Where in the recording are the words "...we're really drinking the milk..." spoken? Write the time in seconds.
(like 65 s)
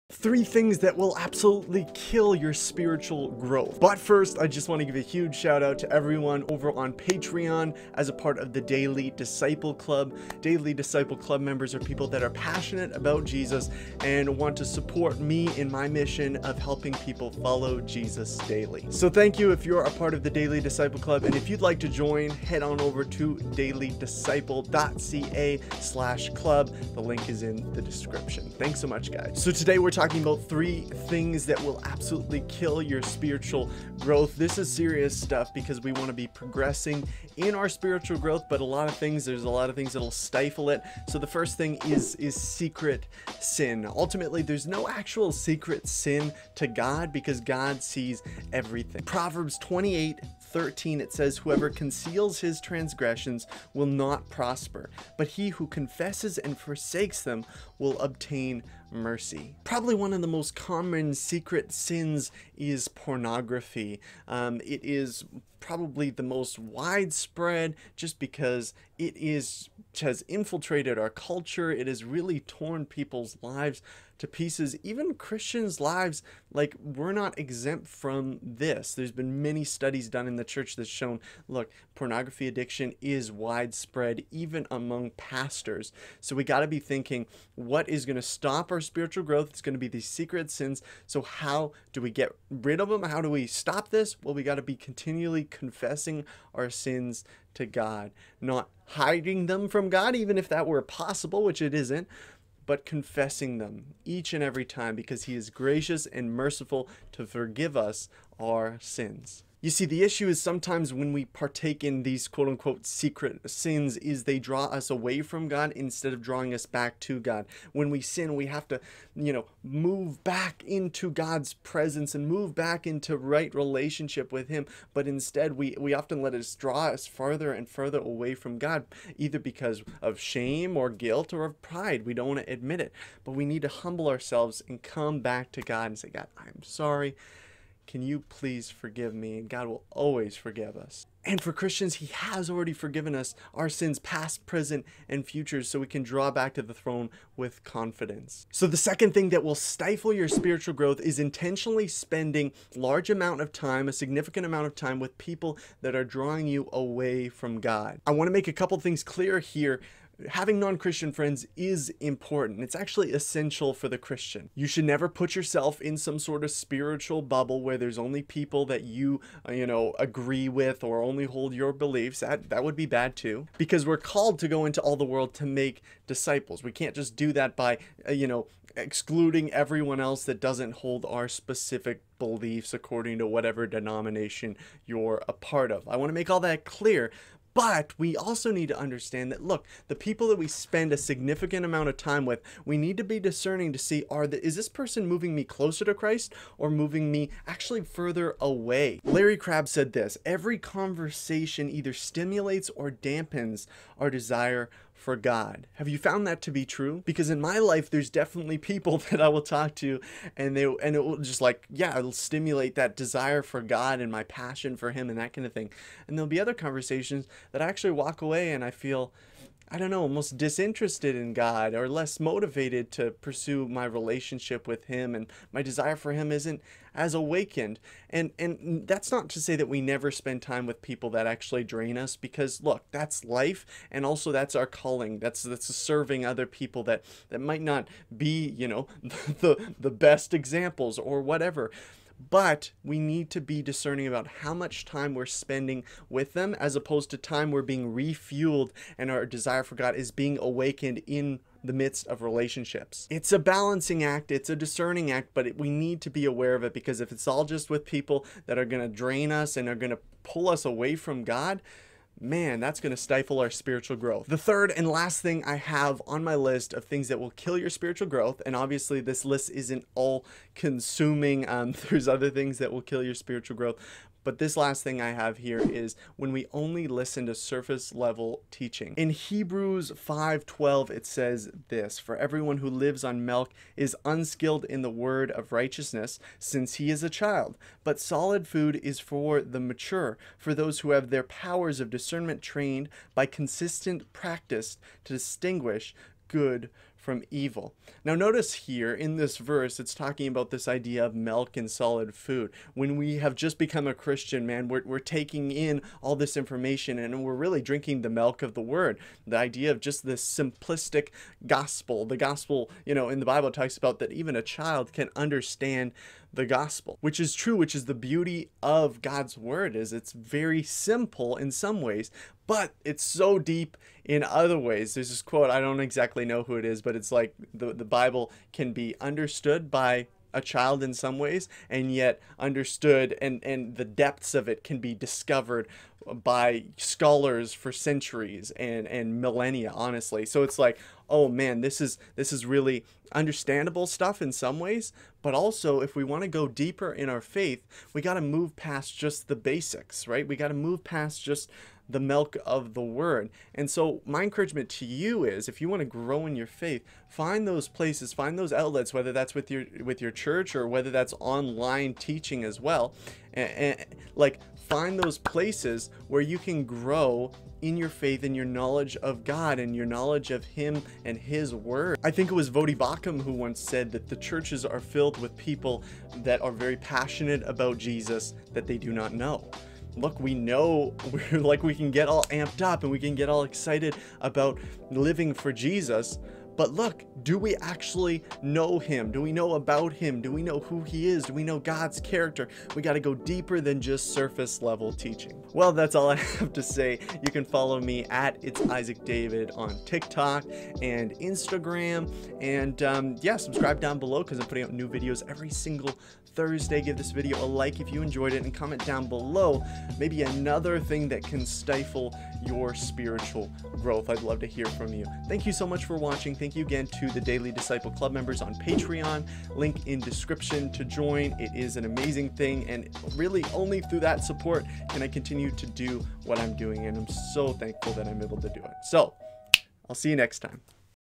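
307 s.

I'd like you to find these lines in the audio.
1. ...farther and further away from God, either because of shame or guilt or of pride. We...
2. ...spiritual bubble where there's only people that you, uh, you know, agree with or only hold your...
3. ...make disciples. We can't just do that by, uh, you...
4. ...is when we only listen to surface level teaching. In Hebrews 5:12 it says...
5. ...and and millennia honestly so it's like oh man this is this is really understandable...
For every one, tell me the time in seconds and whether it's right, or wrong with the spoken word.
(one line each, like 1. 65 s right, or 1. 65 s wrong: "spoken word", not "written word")
1. 127 s right
2. 166 s right
3. 175 s right
4. 275 s right
5. 338 s right.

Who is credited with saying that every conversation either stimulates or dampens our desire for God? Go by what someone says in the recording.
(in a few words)
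Larry Crabb.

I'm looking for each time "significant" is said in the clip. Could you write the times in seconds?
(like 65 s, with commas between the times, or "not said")
153 s, 190 s.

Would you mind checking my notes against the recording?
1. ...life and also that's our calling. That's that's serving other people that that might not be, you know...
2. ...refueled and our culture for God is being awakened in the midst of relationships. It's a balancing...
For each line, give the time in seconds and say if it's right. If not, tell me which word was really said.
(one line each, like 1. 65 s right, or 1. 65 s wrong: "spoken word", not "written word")
1. 233 s right
2. 247 s wrong: "desire", not "culture".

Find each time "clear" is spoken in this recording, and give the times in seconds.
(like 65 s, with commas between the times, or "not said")
159 s, 186 s.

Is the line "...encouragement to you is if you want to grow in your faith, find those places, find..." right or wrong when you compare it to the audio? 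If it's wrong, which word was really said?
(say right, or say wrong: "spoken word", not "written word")
right.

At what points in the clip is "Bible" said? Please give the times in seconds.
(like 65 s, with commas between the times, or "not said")
313 s, 327 s.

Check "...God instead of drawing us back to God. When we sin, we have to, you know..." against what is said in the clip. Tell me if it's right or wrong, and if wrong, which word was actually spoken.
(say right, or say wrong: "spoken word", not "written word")
right.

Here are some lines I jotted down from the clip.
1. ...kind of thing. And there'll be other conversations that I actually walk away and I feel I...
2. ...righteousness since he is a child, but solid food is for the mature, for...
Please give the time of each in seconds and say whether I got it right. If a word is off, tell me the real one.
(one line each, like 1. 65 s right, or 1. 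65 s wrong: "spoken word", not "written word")
1. 215 s right
2. 285 s right.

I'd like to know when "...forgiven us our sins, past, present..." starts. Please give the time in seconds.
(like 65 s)
142 s.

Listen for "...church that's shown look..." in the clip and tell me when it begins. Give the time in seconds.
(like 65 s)
80 s.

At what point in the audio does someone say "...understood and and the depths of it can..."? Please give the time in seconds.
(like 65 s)
332 s.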